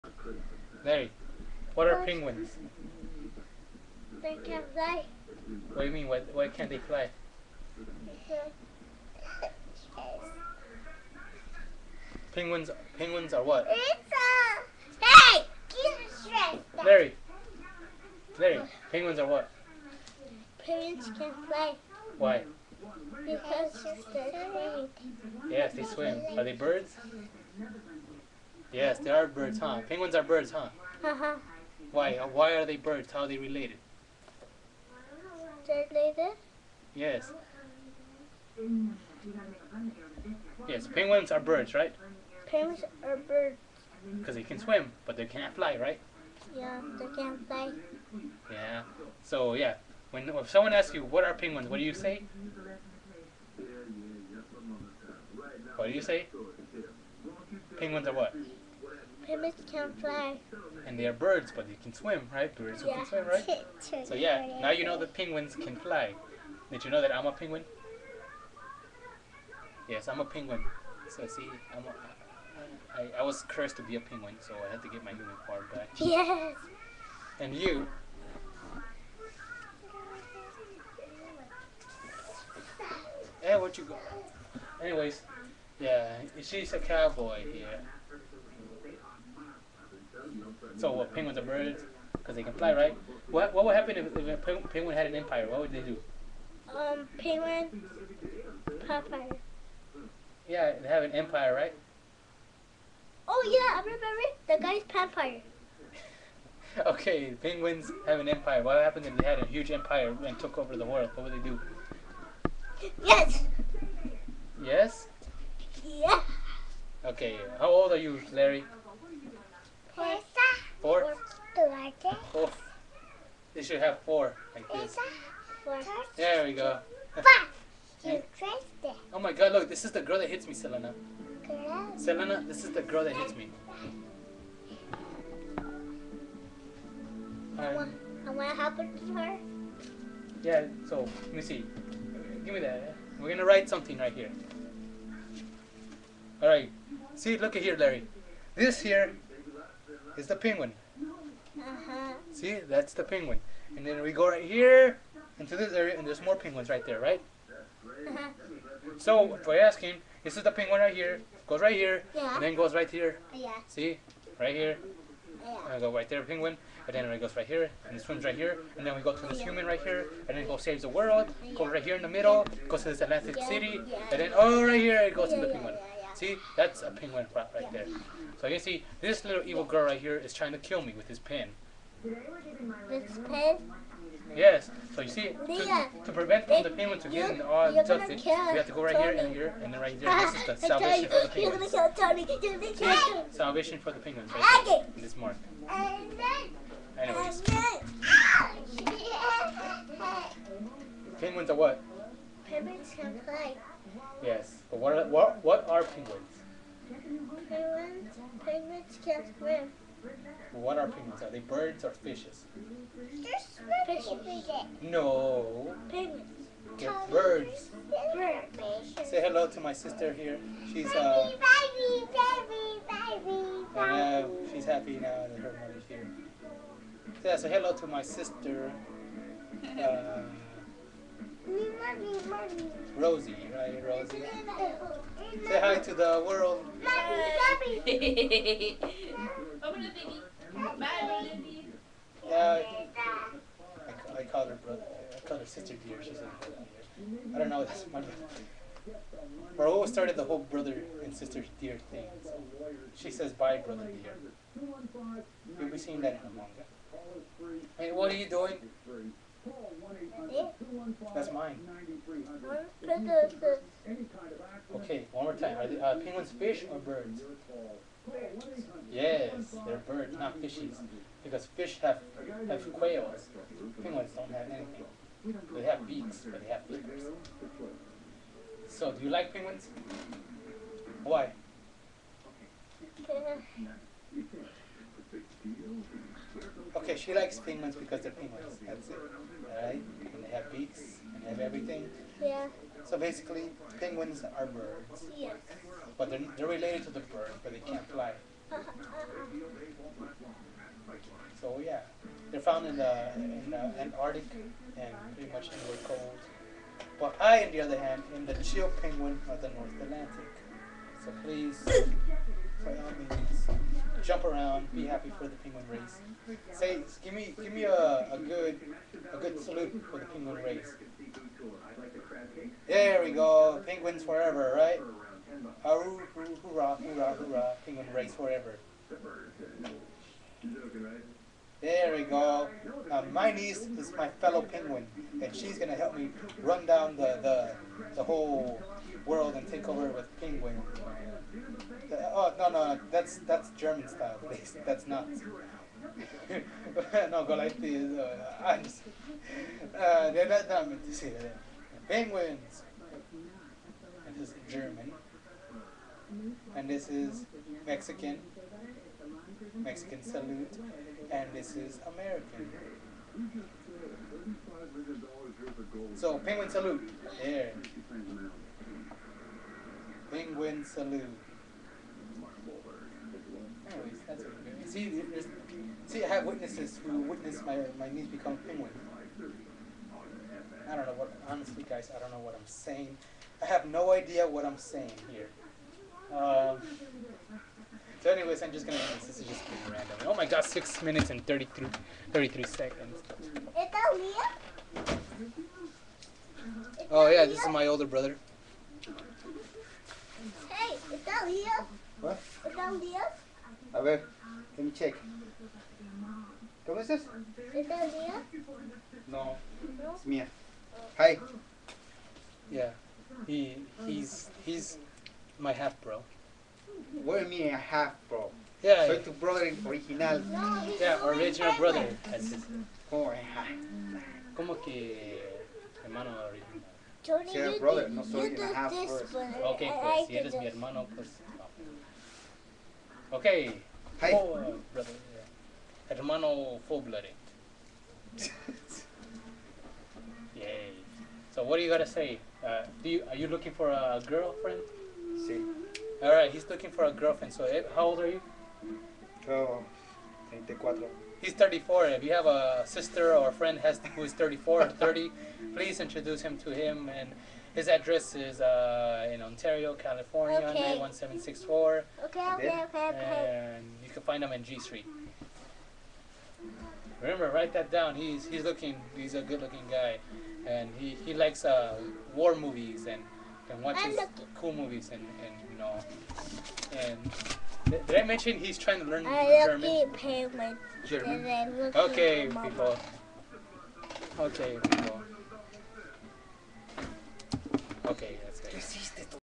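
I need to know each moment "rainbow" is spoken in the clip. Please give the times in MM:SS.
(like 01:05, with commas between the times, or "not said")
not said.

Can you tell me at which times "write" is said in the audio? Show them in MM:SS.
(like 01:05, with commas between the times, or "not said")
02:23, 07:47.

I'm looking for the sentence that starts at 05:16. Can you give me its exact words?
Say, give me, give me a, a good, a good salute for the penguin race.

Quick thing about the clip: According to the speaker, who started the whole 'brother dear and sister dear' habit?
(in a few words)
Raul.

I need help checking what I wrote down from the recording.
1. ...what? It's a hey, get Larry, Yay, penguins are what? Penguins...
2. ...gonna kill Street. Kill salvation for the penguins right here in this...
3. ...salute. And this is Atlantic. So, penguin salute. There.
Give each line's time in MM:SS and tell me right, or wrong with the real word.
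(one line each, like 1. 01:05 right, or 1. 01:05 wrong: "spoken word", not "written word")
1. 00:13 wrong: "Larry", not "Yay"
2. 03:11 wrong: "Tony", not "Street"
3. 06:00 wrong: "American", not "Atlantic".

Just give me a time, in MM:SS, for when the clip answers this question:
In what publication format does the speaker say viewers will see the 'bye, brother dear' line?
04:16.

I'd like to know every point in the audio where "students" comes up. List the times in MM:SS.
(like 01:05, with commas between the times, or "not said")
not said.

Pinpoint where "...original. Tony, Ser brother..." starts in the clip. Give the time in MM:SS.
07:06.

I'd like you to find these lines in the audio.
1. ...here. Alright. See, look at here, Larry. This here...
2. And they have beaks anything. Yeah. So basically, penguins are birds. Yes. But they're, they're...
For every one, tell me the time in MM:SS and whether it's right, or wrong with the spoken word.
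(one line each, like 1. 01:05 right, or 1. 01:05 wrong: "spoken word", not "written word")
1. 02:24 right
2. 04:50 wrong: "everything", not "anything".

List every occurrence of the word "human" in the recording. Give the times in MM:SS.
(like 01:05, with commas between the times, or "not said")
01:15, 02:49.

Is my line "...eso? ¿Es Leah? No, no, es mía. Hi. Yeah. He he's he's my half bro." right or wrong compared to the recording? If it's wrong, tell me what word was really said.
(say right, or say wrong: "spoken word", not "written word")
right.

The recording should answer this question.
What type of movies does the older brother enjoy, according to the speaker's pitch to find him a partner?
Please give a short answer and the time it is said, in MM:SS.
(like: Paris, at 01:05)
war movies, at 07:52.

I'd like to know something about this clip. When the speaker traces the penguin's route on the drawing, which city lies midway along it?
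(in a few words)
Atlantic City.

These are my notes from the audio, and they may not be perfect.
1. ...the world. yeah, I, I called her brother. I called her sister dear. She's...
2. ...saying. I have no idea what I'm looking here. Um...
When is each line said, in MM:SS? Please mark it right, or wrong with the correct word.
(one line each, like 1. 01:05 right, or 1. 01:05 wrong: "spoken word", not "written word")
1. 03:55 right
2. 06:22 wrong: "saying", not "looking".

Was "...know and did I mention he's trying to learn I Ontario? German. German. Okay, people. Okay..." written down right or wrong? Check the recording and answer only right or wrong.
wrong.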